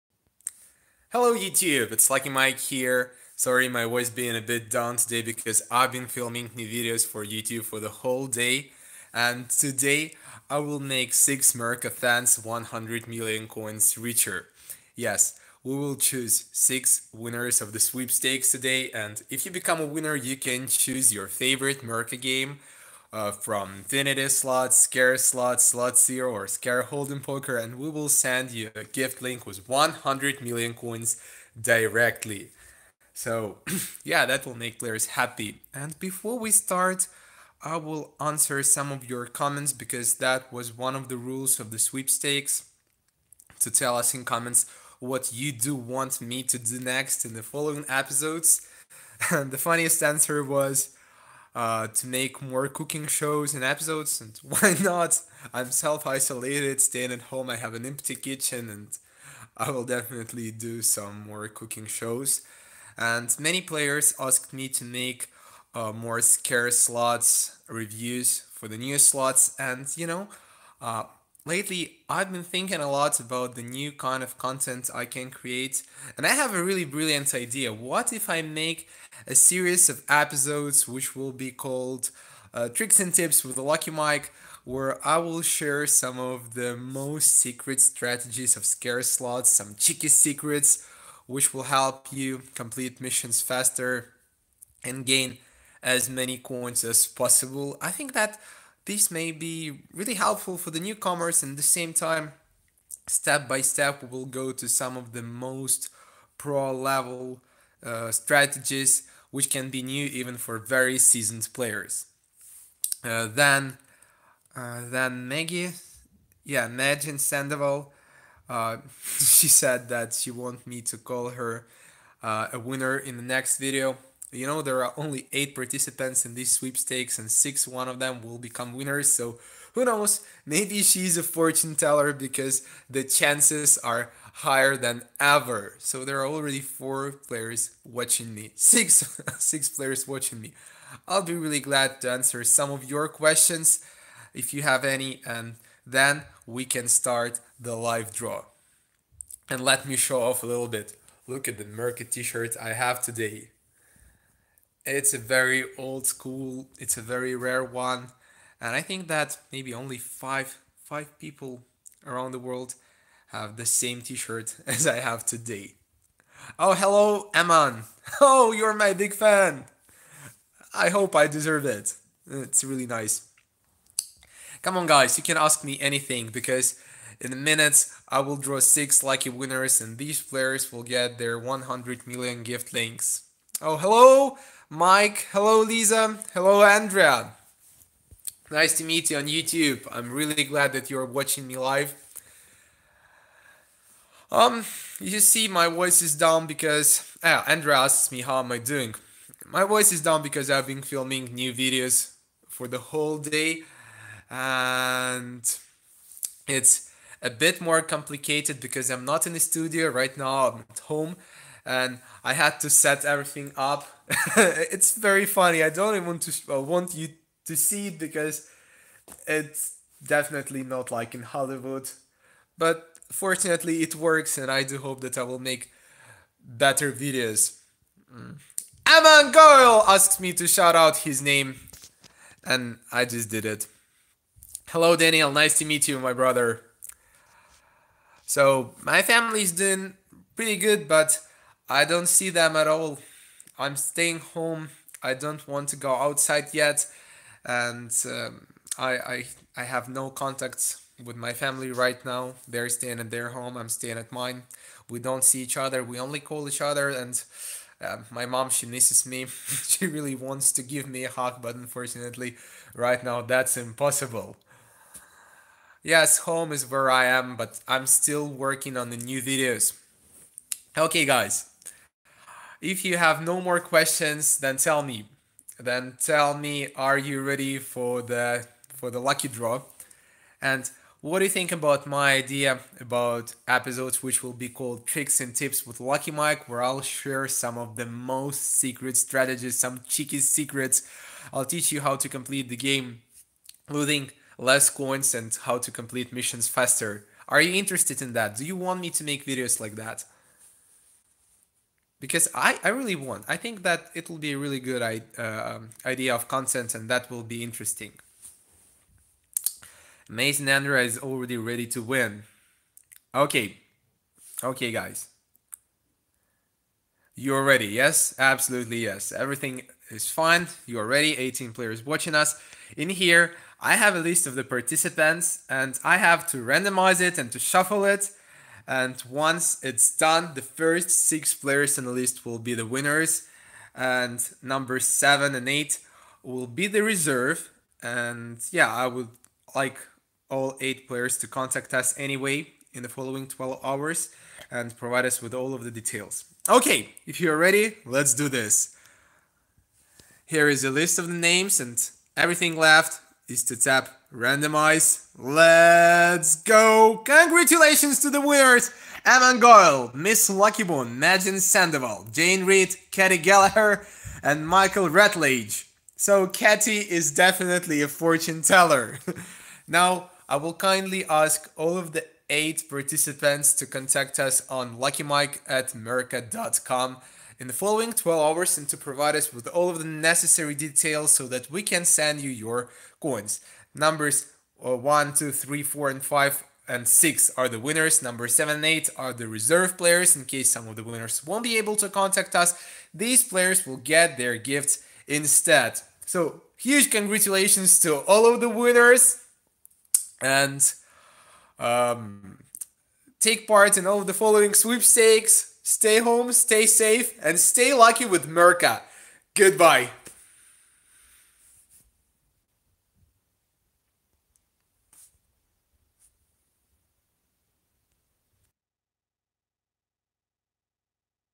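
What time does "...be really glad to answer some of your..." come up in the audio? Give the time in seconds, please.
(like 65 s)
141 s.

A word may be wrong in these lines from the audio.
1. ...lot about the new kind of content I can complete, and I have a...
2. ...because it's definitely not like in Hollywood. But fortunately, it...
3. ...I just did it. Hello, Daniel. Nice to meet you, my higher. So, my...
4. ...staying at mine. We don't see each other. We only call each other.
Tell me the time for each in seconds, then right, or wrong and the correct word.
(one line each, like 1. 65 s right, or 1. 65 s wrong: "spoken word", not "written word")
1. 72 s wrong: "create", not "complete"
2. 217 s right
3. 232 s wrong: "brother", not "higher"
4. 253 s right.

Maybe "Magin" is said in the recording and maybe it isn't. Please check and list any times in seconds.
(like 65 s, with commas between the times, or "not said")
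116 s, 360 s.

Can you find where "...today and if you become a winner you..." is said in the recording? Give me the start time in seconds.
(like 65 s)
18 s.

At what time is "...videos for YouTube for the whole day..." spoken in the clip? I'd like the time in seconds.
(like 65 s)
6 s.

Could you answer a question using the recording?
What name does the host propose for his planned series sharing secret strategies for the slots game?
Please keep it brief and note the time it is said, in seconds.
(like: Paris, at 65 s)
Tricks and Tips with the Lucky Mike, at 82 s.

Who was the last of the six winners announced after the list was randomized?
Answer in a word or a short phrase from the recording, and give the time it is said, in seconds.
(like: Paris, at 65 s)
Michael Ratledge, at 364 s.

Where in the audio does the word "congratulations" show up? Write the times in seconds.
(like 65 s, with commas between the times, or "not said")
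357 s, 396 s.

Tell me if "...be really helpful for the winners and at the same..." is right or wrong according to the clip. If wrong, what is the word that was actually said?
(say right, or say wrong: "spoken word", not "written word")
wrong: "newcomers", not "winners".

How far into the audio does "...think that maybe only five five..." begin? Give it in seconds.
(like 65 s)
158 s.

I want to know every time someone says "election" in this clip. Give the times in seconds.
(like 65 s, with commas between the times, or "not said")
not said.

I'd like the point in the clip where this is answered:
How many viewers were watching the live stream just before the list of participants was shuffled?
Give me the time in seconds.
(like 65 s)
321 s.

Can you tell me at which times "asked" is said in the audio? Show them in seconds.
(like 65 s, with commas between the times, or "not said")
64 s, 229 s.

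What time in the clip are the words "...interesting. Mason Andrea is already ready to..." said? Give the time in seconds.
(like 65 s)
307 s.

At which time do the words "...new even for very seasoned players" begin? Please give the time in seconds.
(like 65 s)
109 s.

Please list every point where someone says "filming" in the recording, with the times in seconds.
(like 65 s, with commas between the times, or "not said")
6 s, 200 s.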